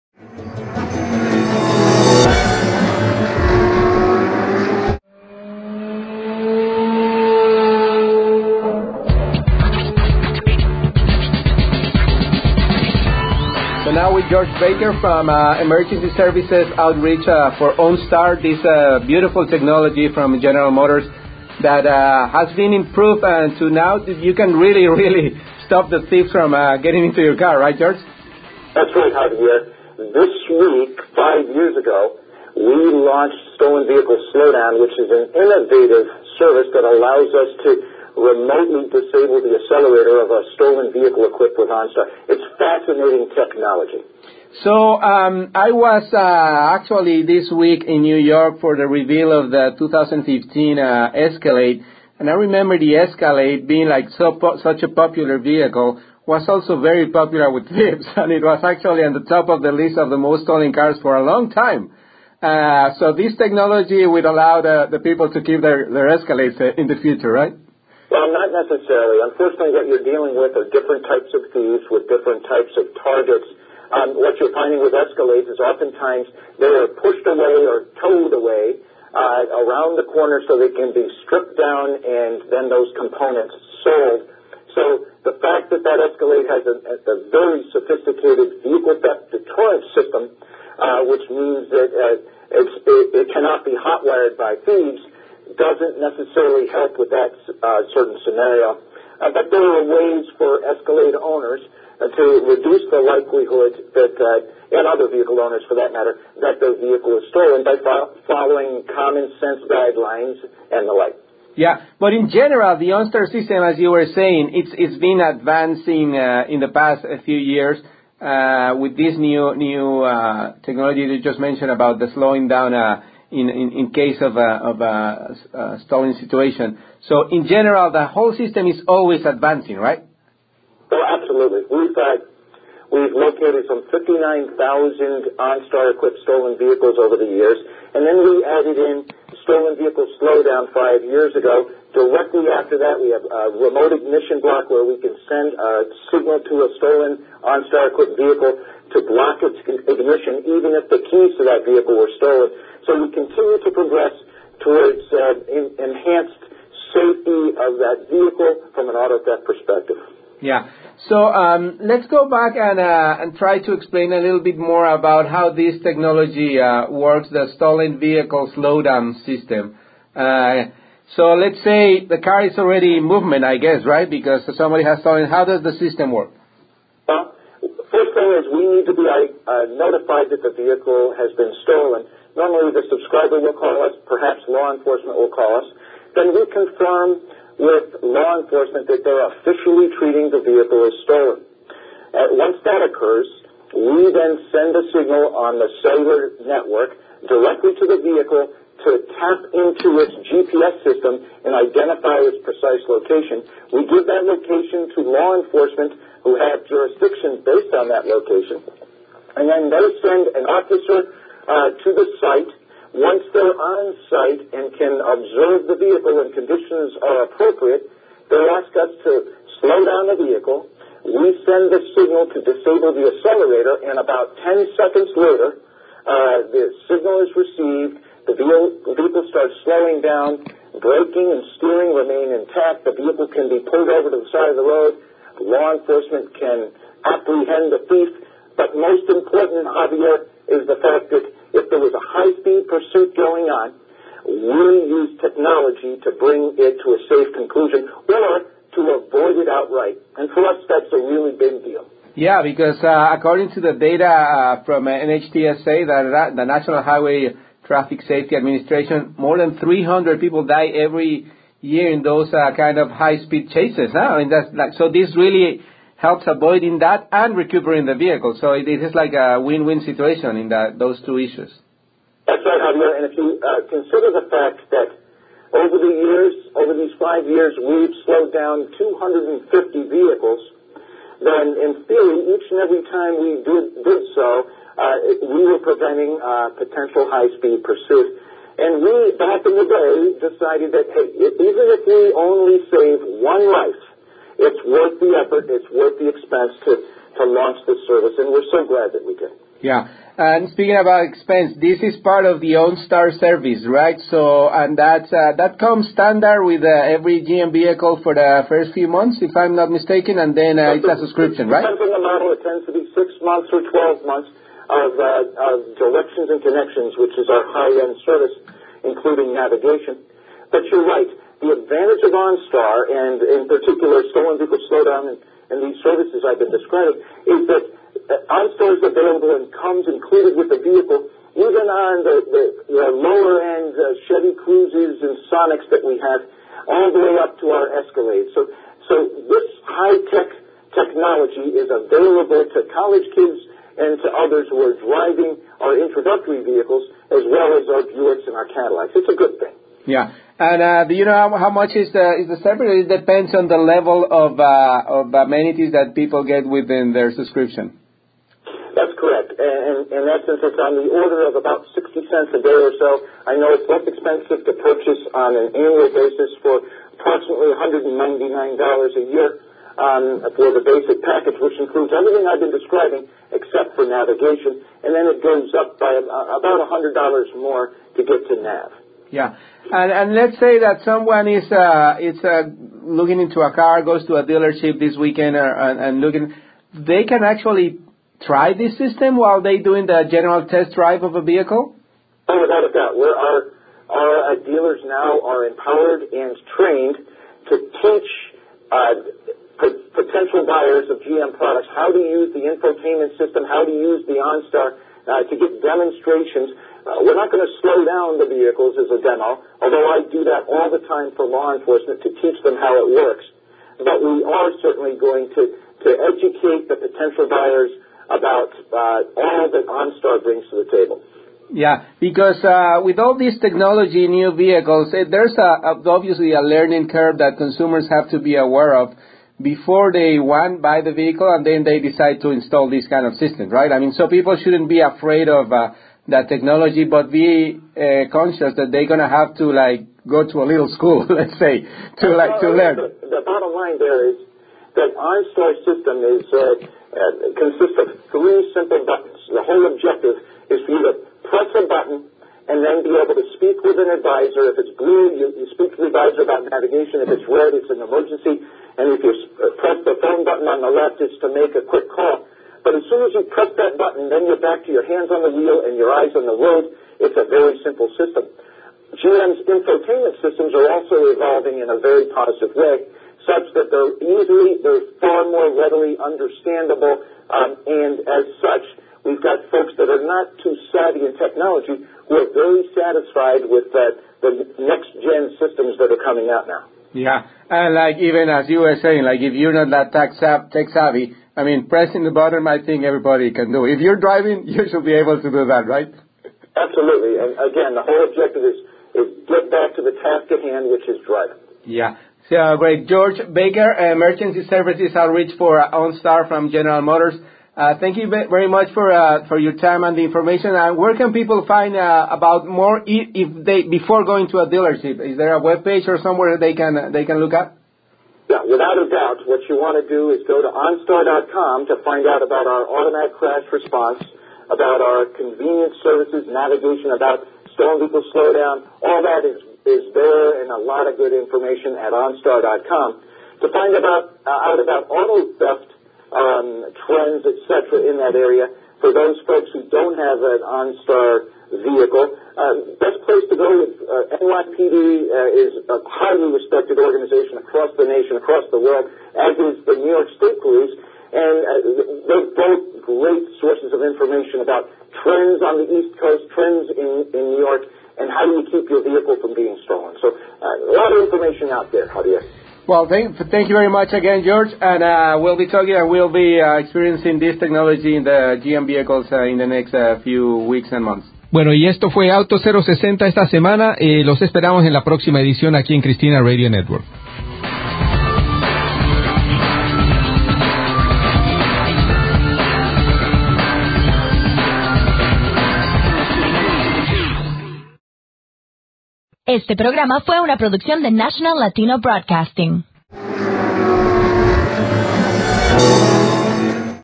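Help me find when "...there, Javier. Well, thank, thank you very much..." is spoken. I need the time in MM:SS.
09:21.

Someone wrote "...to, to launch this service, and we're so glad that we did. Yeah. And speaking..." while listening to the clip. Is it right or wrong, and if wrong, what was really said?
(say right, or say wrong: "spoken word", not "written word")
right.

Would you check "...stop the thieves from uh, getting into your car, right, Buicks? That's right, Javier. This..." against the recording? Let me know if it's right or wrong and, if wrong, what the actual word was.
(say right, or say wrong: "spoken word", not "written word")
wrong: "George", not "Buicks".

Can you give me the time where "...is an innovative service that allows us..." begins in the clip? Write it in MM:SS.
00:34.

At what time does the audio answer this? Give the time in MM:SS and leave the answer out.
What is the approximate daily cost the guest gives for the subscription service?
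06:01.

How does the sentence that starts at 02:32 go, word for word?
So We continue to progress towards uh, enhanced safety of that vehicle from an auto theft perspective.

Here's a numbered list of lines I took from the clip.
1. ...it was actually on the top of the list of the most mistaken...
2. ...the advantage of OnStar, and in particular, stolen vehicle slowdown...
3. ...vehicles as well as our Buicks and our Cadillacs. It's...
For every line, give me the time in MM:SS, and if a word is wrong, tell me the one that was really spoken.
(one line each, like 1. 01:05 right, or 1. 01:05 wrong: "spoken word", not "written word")
1. 00:58 wrong: "stolen", not "mistaken"
2. 05:21 right
3. 05:46 right.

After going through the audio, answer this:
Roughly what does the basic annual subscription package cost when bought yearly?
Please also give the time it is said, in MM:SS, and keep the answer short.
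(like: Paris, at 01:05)
$199, at 06:07.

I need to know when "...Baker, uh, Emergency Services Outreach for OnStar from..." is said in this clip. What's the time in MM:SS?
08:23.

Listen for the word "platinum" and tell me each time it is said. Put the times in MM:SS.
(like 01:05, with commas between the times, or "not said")
not said.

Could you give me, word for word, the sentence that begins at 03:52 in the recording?
The vehicle can be pulled over to the side of the road.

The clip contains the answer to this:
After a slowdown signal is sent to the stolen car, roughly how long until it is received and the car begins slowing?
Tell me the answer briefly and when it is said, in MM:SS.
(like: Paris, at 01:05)
10 seconds, at 03:44.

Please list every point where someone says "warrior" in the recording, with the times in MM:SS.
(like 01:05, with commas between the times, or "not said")
not said.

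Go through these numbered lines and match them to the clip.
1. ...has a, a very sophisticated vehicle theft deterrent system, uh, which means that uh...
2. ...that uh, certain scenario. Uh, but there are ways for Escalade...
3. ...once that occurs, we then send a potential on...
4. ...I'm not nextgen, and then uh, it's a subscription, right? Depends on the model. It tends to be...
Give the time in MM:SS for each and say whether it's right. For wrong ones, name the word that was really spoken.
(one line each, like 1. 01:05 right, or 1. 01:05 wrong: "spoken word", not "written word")
1. 01:26 right
2. 01:37 right
3. 03:12 wrong: "signal", not "potential"
4. 05:09 wrong: "mistaken", not "nextgen".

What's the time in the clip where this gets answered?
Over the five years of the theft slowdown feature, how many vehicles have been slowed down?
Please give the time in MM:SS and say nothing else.
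04:38.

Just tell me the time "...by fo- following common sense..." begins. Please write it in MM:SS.
01:47.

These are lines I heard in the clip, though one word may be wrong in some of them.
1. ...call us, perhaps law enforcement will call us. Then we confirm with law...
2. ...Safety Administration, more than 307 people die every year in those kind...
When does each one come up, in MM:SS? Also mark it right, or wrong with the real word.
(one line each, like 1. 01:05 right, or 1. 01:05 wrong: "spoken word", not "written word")
1. 03:03 right
2. 04:18 wrong: "300", not "307".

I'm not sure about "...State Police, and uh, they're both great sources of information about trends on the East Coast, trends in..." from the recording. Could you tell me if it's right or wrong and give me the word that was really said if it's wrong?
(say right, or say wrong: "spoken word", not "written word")
right.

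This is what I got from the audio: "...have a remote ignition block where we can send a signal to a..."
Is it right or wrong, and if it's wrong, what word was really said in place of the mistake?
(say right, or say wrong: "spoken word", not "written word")
right.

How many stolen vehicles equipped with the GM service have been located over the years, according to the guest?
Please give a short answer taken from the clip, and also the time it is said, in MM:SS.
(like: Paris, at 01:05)
59,000, at 02:13.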